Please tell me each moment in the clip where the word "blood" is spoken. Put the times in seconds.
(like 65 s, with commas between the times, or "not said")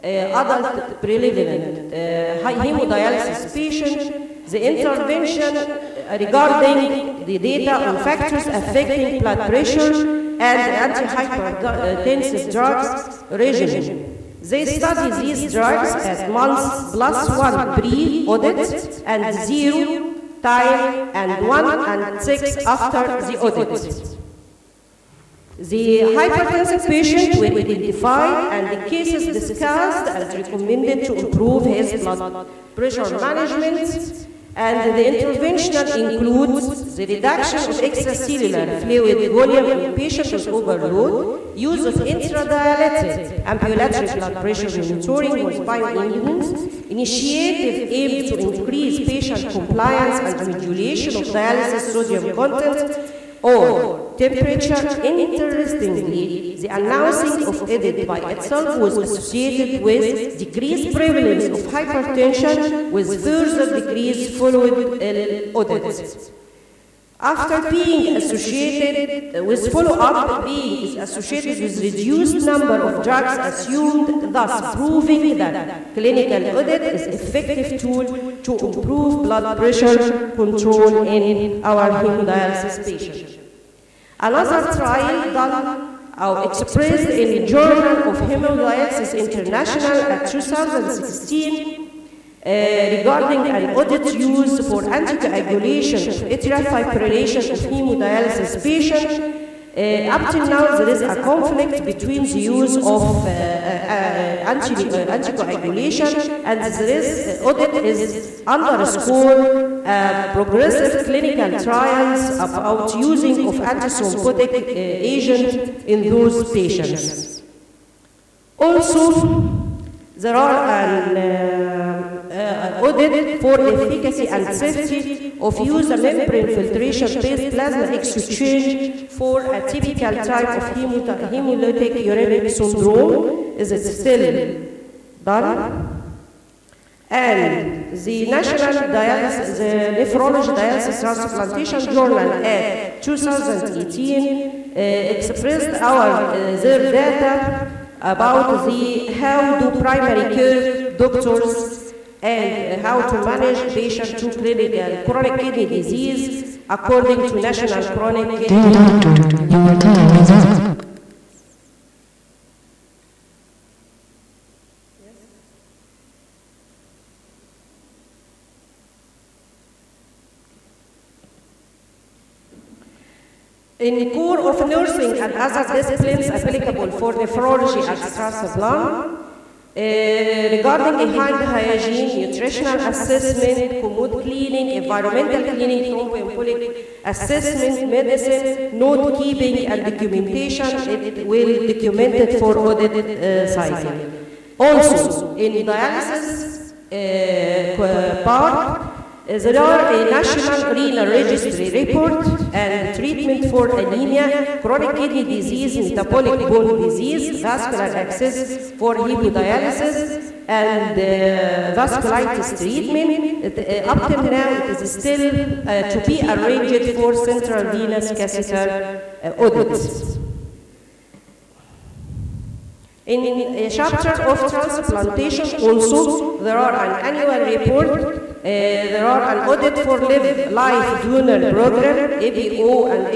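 9 s, 31 s, 44 s, 79 s.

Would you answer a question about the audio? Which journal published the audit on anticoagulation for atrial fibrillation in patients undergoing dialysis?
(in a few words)
Hemodialysis International.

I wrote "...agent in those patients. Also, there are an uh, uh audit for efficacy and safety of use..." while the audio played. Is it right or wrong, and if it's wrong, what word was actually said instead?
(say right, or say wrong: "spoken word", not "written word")
right.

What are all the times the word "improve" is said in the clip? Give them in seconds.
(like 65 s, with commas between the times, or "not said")
31 s, 78 s.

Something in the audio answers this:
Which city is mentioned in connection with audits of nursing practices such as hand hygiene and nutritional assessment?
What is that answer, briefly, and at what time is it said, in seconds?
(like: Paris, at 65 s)
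Strasbourg, at 178 s.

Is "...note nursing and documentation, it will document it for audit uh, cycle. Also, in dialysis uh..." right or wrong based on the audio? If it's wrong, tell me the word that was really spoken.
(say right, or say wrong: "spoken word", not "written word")
wrong: "keeping", not "nursing".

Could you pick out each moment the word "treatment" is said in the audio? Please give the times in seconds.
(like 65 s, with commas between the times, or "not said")
202 s, 212 s.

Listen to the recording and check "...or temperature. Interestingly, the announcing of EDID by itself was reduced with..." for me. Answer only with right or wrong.
wrong.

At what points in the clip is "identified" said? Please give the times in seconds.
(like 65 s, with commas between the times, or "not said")
27 s.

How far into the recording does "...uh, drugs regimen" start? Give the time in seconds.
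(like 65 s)
12 s.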